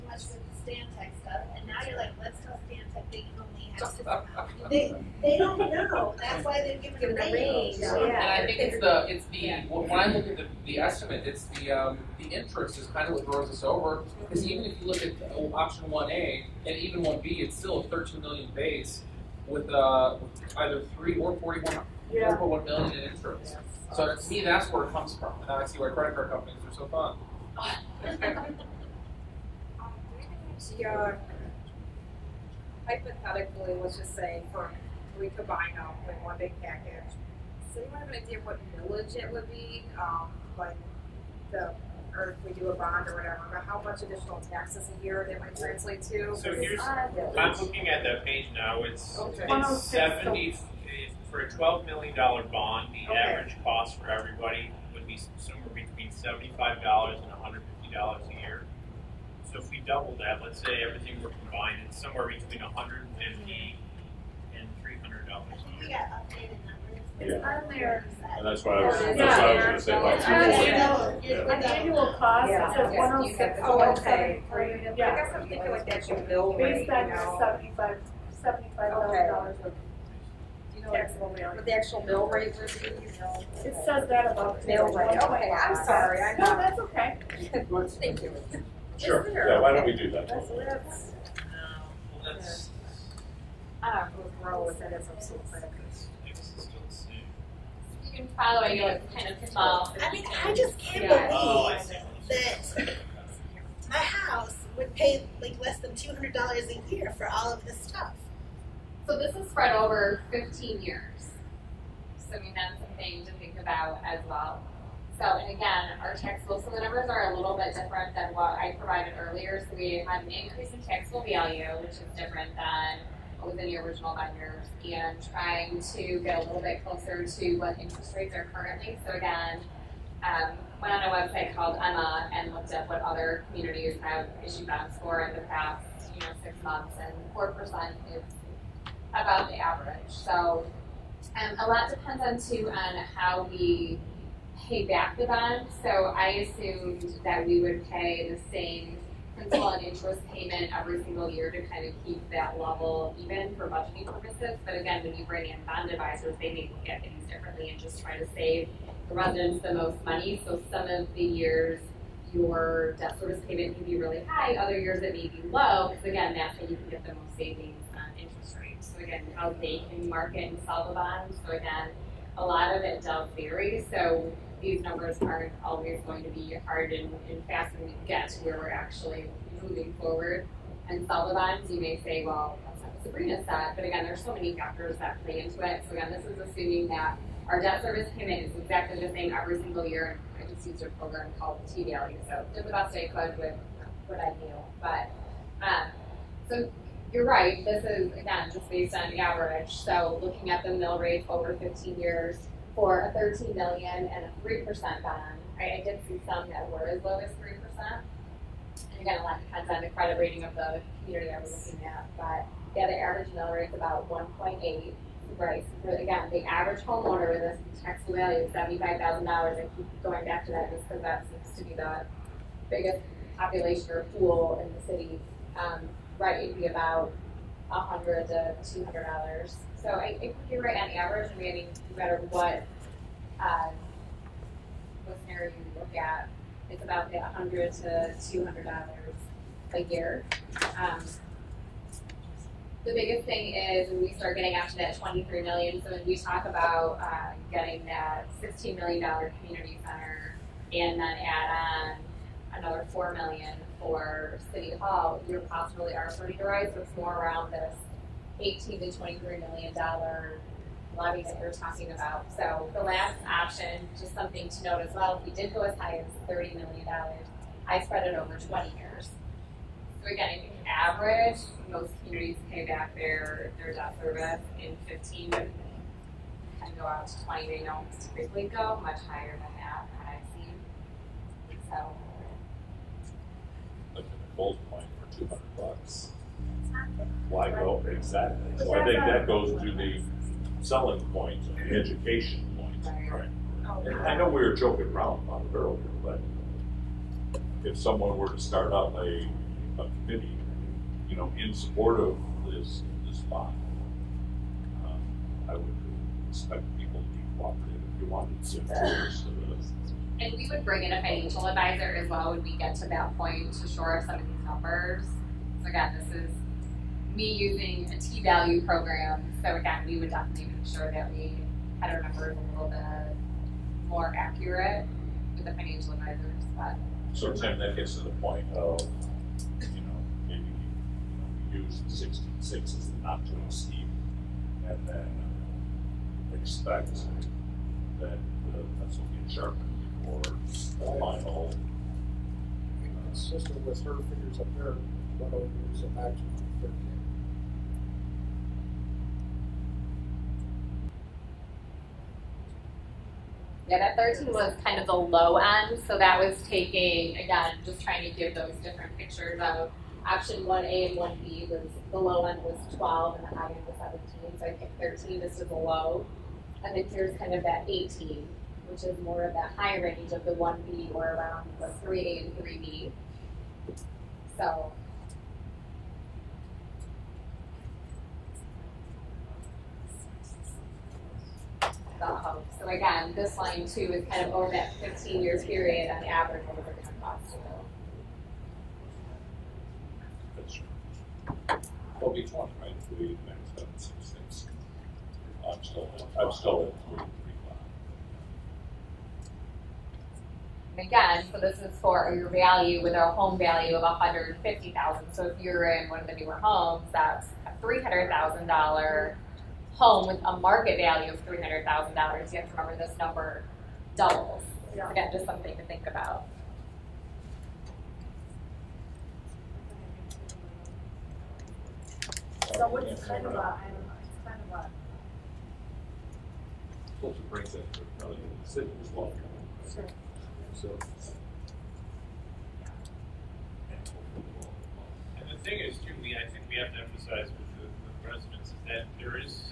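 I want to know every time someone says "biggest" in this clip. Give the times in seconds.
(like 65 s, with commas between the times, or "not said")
222 s, 242 s.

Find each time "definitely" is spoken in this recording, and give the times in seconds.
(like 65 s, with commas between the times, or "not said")
320 s.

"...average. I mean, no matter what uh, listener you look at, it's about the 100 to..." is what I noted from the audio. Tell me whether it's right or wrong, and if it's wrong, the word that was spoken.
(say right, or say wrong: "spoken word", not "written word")
right.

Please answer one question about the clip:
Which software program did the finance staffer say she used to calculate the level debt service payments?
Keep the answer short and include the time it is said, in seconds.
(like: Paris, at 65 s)
T Value, at 191 s.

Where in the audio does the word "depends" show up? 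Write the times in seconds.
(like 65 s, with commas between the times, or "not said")
141 s, 209 s.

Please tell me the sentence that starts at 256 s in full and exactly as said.
So it's more around this 18 to 23 million dollar levies that we are talking about.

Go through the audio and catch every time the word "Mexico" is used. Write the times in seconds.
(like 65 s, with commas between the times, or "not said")
not said.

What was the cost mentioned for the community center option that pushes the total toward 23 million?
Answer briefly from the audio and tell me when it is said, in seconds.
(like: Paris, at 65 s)
16 million dollars, at 248 s.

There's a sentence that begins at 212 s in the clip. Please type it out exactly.
But yeah, the average mill rate is about 1.8.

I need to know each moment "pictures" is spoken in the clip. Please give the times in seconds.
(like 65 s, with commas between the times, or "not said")
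358 s.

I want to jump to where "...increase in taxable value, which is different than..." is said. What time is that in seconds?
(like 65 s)
120 s.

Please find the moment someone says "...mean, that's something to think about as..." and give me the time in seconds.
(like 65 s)
112 s.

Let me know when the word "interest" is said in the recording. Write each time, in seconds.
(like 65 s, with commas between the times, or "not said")
12 s, 23 s, 127 s, 149 s, 168 s.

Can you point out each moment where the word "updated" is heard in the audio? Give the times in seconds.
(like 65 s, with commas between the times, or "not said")
66 s.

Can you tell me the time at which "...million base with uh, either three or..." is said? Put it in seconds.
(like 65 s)
18 s.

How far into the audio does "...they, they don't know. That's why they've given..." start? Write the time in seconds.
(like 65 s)
4 s.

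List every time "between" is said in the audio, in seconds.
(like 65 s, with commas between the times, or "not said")
55 s, 62 s.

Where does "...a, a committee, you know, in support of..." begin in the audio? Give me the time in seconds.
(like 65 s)
298 s.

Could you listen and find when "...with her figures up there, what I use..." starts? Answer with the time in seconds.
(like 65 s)
343 s.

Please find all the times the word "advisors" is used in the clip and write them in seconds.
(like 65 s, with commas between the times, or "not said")
155 s, 311 s, 325 s.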